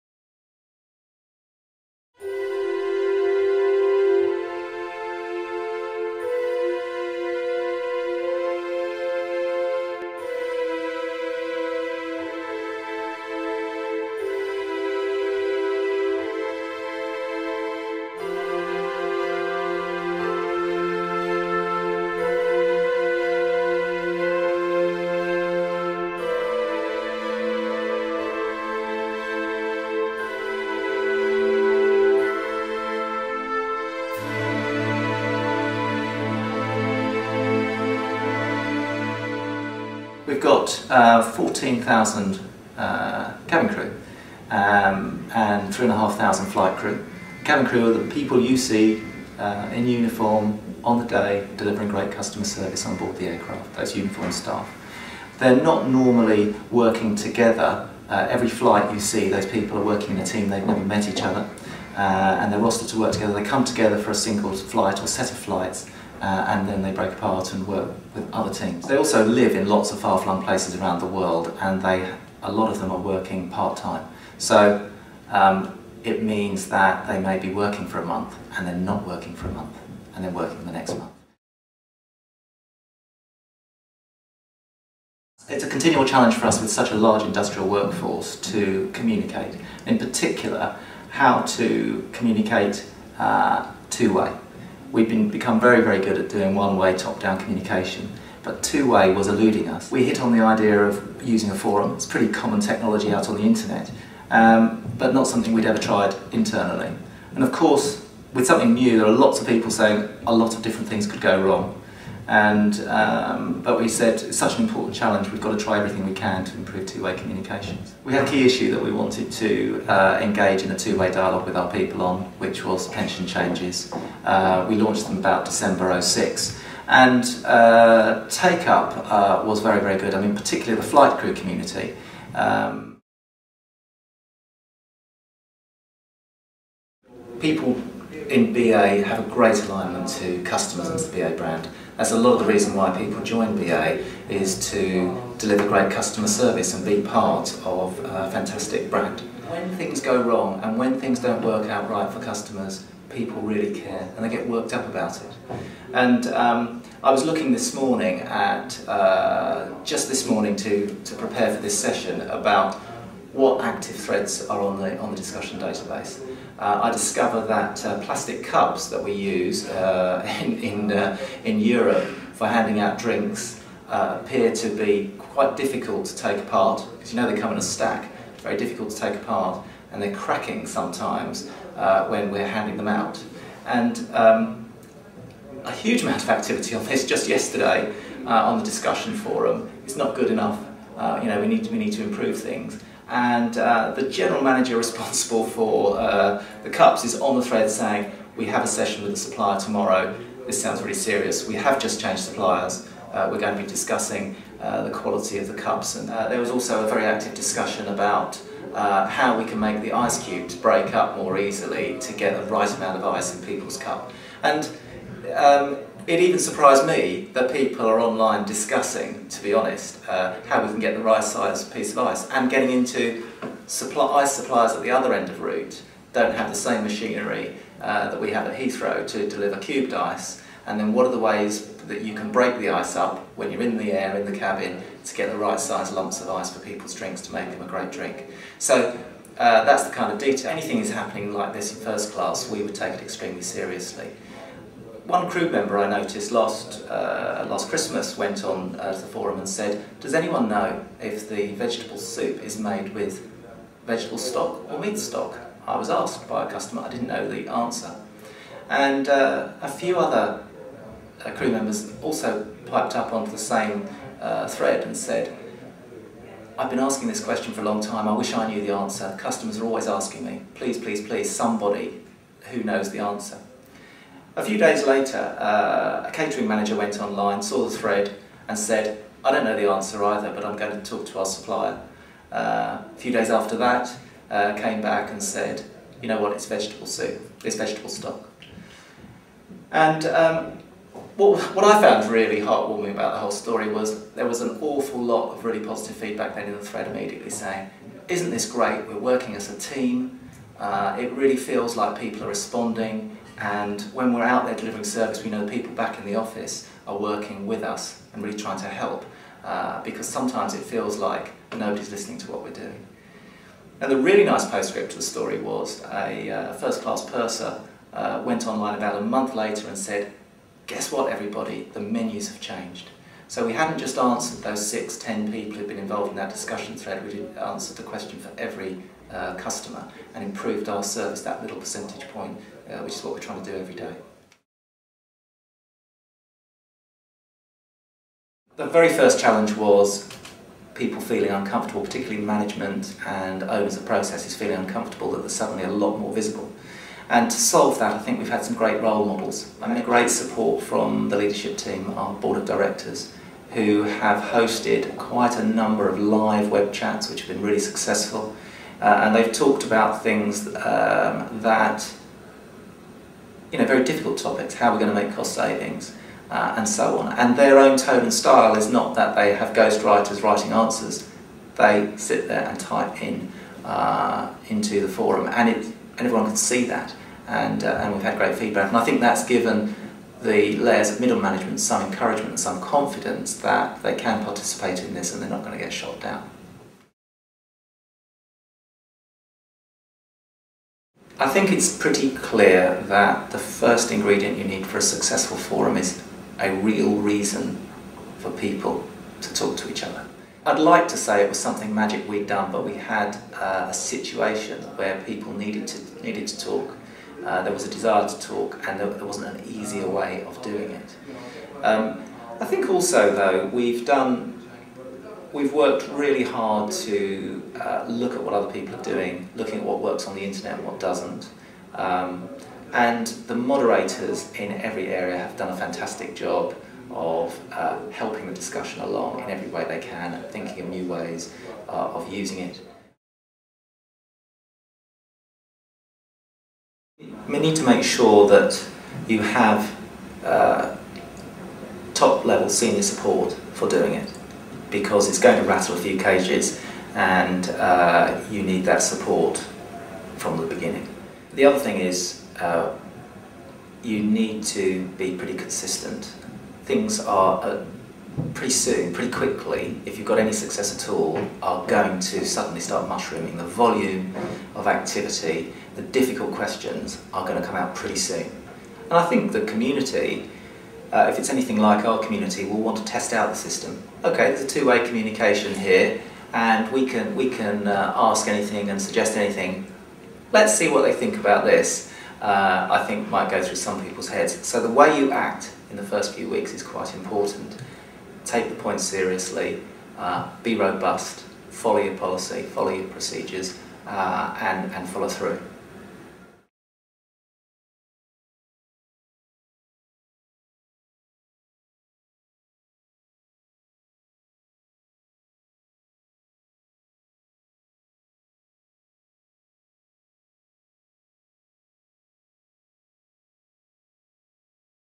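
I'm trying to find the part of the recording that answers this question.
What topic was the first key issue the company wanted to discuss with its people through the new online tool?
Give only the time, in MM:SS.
02:02.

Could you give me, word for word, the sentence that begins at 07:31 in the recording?
The other thing is uh, you need to be pretty consistent.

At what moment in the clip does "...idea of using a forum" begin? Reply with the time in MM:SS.
01:40.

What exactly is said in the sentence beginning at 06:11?
They sit there and type in uh, into the forum, and it, everyone can see that.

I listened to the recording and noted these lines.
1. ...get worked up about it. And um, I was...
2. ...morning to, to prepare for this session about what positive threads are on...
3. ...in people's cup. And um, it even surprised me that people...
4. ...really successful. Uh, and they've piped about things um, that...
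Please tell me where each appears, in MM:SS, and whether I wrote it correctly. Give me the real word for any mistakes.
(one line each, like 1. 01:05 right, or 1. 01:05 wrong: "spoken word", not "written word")
1. 02:34 right
2. 02:40 wrong: "active", not "positive"
3. 03:33 right
4. 05:57 wrong: "talked", not "piped".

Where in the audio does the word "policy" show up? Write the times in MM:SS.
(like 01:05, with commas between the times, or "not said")
08:11.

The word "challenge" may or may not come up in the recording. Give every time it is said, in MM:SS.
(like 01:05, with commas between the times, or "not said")
01:26, 01:54, 05:39.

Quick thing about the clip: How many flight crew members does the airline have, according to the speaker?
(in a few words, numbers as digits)
3,500.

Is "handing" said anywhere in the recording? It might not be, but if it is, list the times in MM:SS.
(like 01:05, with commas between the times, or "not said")
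02:52, 03:02.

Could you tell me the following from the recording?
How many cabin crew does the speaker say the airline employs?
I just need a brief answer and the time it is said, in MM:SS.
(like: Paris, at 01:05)
14,000, at 00:41.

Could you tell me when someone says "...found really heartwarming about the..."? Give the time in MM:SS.
04:51.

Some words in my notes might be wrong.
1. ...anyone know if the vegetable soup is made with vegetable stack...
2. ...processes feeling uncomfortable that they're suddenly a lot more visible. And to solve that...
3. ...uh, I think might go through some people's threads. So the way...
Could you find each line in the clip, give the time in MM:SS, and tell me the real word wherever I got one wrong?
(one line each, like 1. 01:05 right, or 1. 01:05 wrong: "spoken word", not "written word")
1. 04:10 wrong: "stock", not "stack"
2. 05:43 right
3. 08:02 wrong: "heads", not "threads".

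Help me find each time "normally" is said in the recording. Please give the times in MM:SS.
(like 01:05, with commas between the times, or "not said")
00:55.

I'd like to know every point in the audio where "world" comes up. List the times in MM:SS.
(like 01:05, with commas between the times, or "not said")
01:11.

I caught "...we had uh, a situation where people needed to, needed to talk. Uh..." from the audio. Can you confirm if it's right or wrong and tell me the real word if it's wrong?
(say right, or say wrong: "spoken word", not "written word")
right.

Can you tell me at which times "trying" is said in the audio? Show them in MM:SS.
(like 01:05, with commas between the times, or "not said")
05:08, 05:33.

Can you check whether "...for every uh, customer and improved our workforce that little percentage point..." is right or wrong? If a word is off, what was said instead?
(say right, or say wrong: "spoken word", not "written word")
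wrong: "service", not "workforce".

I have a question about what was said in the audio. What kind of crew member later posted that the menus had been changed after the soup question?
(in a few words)
first-class purser.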